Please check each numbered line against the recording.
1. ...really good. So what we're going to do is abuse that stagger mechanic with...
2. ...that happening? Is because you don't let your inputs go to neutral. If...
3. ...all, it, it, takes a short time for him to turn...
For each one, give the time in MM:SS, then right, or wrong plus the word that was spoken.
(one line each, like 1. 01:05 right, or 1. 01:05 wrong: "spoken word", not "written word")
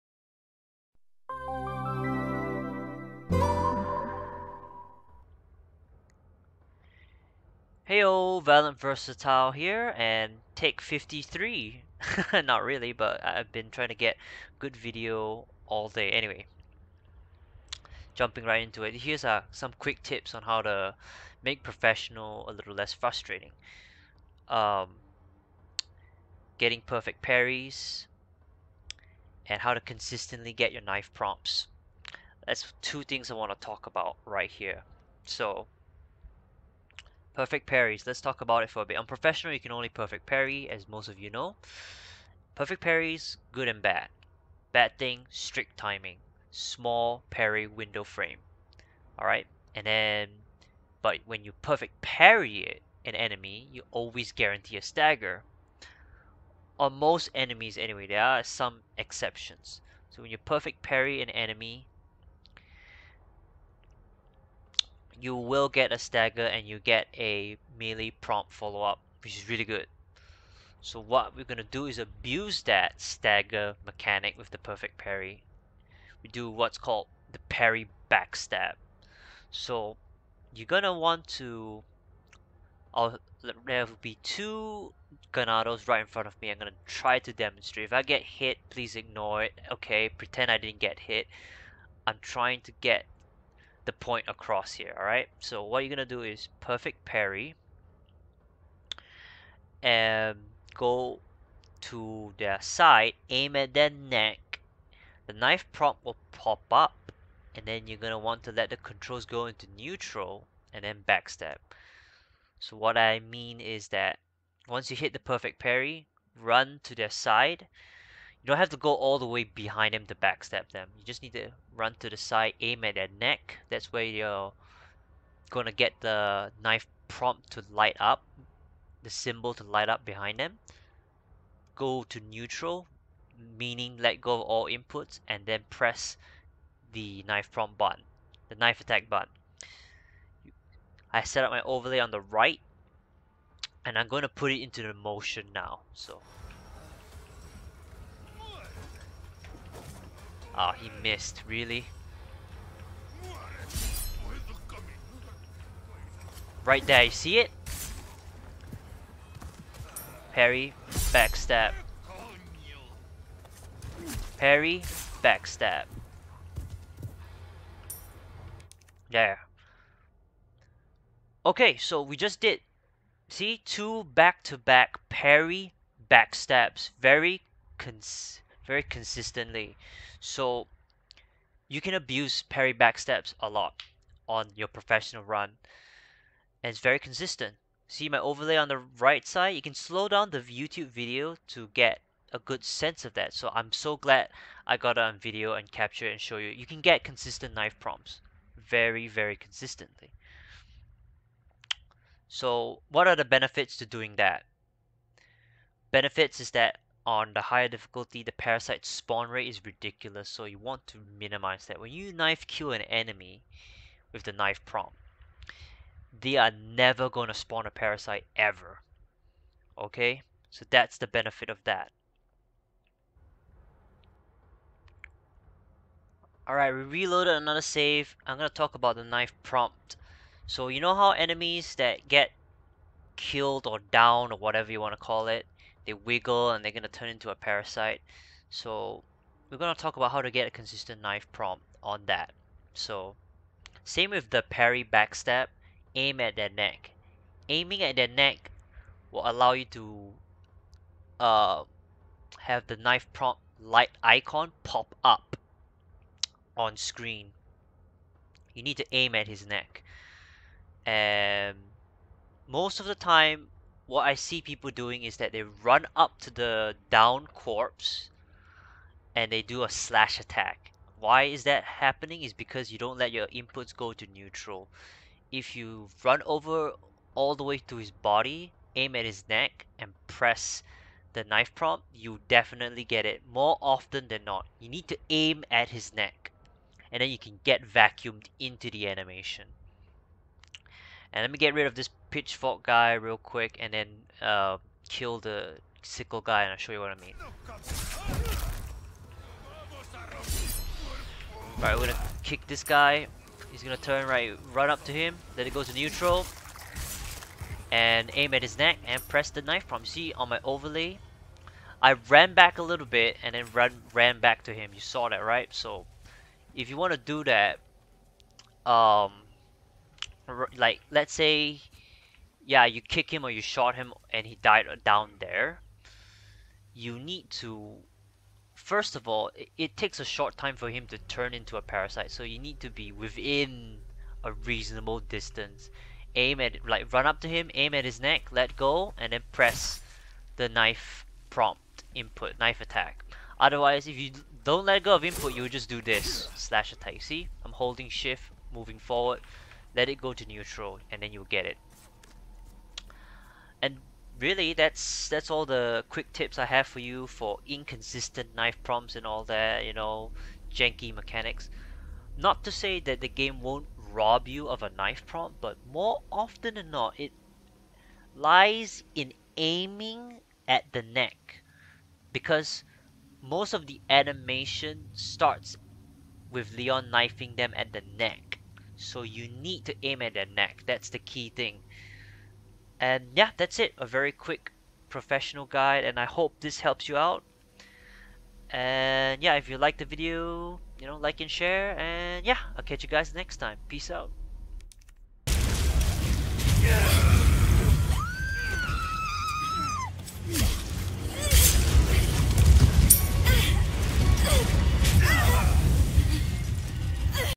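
1. 01:09 right
2. 04:31 right
3. 05:29 right.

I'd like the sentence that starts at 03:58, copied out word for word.
So we're going to talk about how to get a consistent knife prompt on that.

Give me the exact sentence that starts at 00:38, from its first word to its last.
On professional, you can only perfect parry, as most of you know.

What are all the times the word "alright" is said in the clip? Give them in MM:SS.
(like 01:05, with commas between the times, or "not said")
00:49, 01:34, 03:46, 05:01.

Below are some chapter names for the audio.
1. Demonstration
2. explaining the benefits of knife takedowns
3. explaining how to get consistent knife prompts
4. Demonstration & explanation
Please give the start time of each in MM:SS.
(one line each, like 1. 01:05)
1. 02:24
2. 02:51
3. 03:44
4. 04:57.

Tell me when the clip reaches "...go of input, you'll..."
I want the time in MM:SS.
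05:44.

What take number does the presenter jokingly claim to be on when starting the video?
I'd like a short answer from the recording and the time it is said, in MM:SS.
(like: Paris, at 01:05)
53, at 00:10.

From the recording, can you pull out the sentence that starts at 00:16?
Anyway, jumping right into it, here's uh, some quick tips on how to make professional a little less frustrating.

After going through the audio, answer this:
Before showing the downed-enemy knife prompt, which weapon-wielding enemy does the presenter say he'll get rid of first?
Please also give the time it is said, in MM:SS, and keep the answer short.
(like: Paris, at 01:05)
pitchfork guy, at 04:52.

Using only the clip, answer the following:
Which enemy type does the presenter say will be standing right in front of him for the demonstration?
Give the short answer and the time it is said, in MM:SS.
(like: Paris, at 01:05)
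Ganados, at 01:25.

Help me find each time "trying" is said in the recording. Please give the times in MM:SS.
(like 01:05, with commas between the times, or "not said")
00:13, 01:32.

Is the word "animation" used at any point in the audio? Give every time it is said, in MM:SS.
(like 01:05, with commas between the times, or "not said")
04:48, 06:13.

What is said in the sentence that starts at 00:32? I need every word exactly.
That's two things I want to talk about right here.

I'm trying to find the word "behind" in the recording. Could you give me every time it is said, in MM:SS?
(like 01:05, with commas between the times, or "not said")
01:59, 02:10.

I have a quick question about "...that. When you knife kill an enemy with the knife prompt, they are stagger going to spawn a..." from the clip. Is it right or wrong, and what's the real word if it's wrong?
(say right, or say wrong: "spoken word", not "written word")
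wrong: "never", not "stagger".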